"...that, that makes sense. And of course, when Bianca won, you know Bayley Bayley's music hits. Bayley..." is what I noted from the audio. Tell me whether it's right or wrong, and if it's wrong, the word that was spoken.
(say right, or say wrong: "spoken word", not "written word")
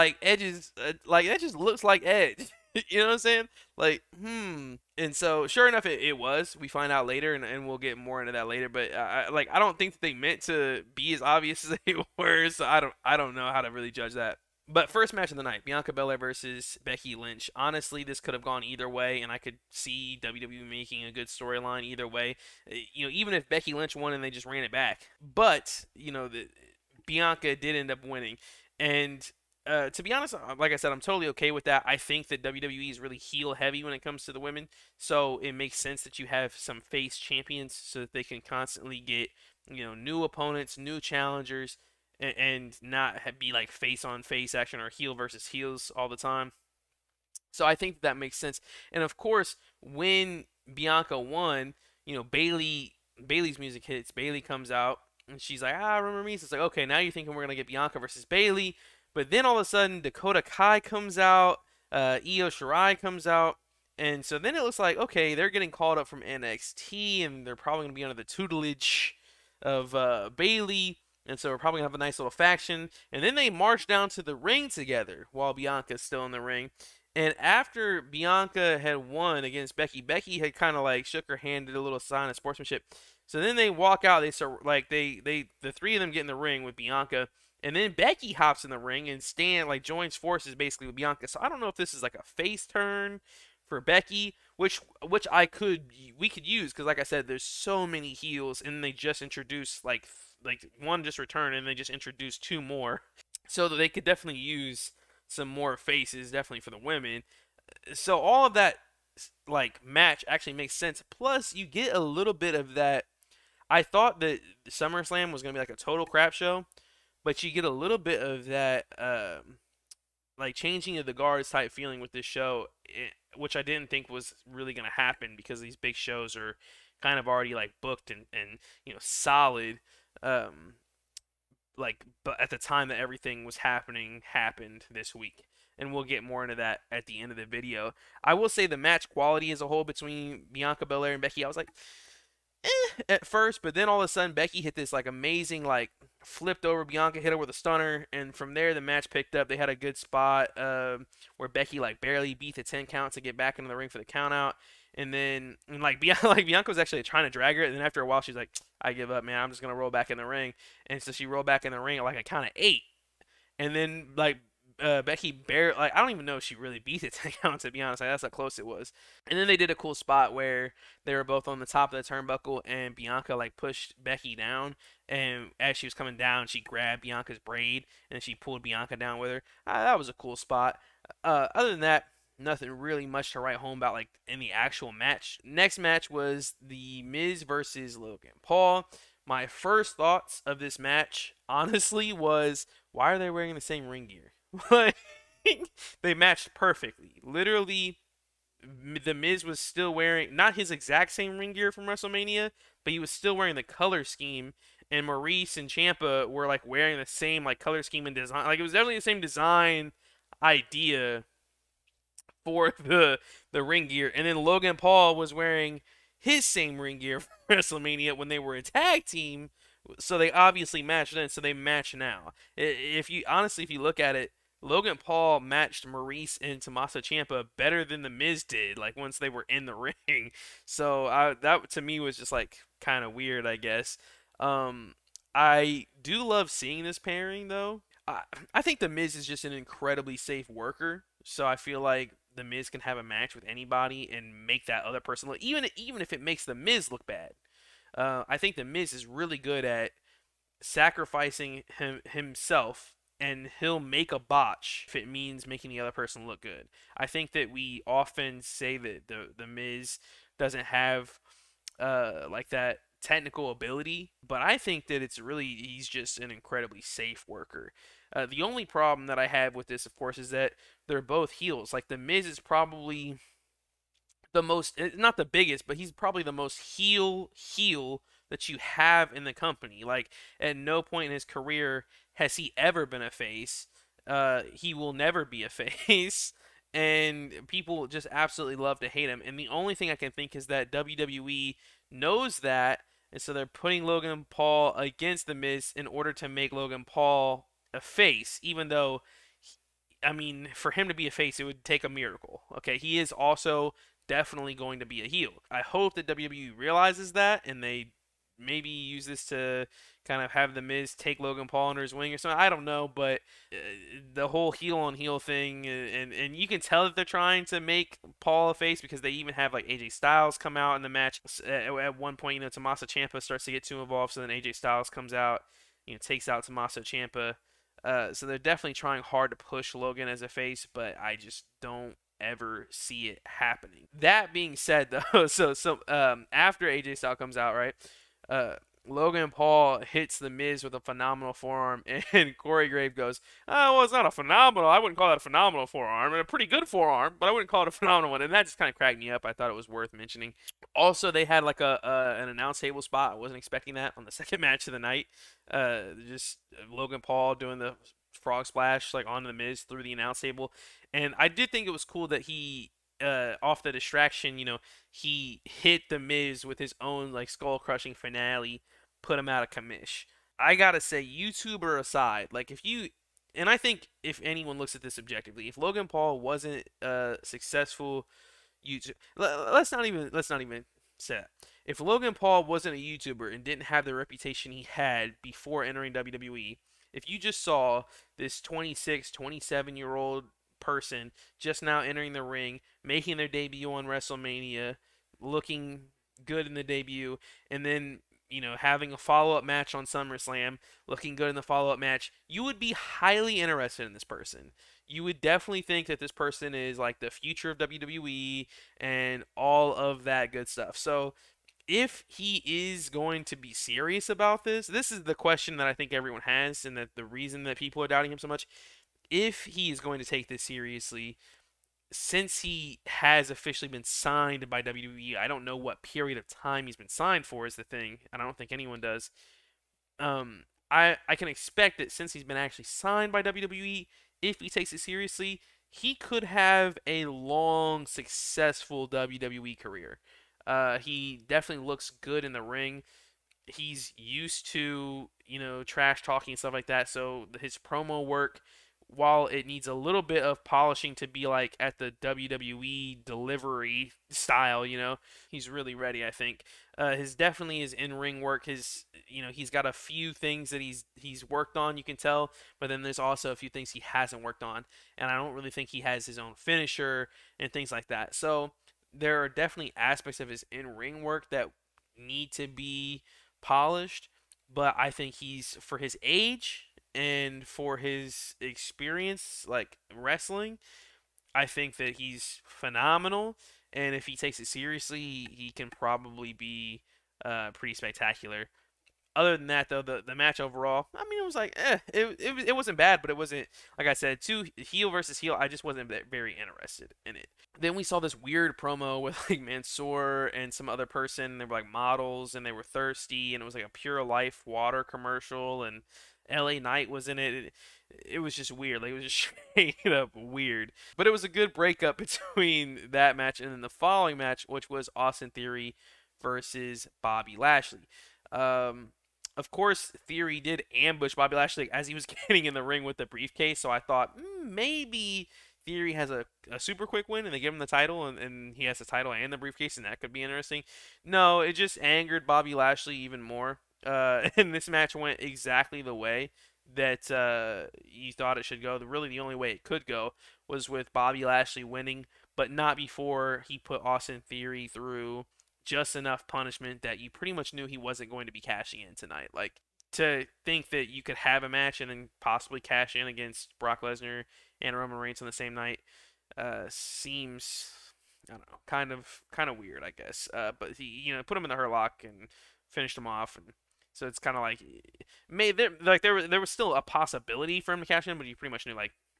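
right.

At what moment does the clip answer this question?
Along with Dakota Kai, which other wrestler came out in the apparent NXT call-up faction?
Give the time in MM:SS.
01:02.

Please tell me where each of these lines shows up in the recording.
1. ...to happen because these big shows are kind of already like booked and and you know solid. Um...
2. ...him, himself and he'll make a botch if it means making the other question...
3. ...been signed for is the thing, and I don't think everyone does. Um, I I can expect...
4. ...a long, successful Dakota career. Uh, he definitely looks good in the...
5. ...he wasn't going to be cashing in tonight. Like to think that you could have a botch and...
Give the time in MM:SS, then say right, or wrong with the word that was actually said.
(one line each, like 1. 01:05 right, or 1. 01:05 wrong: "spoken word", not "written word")
1. 02:04 right
2. 04:11 wrong: "person", not "question"
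3. 07:06 wrong: "anyone", not "everyone"
4. 07:16 wrong: "WWE", not "Dakota"
5. 09:07 wrong: "match", not "botch".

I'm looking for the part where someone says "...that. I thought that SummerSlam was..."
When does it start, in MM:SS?
01:52.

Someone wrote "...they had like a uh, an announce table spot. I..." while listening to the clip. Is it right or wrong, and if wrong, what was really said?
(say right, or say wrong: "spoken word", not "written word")
right.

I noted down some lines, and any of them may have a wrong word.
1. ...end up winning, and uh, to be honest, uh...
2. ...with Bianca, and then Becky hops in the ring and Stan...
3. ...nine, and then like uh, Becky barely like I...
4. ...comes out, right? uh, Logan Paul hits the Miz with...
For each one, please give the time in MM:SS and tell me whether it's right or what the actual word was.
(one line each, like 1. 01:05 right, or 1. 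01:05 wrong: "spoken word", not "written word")
1. 00:27 right
2. 01:26 right
3. 02:42 wrong: "eight", not "nine"
4. 05:37 right.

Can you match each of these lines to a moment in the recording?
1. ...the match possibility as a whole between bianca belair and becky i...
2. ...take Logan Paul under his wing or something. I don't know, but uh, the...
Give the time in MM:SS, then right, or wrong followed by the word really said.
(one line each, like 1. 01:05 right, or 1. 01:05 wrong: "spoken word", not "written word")
1. 02:18 wrong: "quality", not "possibility"
2. 05:10 right.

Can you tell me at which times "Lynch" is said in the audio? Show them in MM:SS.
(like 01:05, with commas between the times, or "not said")
00:17, 00:23.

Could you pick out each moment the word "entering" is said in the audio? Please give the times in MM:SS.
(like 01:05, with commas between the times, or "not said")
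06:25, 06:31.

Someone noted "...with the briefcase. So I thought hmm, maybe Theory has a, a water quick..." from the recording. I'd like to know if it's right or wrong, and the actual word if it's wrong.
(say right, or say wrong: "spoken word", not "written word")
wrong: "super", not "water".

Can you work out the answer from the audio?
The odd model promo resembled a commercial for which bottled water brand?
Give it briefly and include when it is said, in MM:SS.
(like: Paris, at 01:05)
Pure Life, at 08:23.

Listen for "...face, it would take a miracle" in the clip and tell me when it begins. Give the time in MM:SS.
05:01.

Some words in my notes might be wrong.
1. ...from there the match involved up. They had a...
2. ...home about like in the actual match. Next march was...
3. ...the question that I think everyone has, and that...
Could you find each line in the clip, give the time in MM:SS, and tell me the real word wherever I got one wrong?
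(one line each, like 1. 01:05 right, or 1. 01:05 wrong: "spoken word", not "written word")
1. 02:28 wrong: "picked", not "involved"
2. 03:03 wrong: "match", not "march"
3. 06:55 right.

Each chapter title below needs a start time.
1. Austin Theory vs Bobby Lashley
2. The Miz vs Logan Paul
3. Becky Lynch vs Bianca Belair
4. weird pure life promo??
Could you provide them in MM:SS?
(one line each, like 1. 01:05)
1. 08:34
2. 03:04
3. 00:12
4. 08:16.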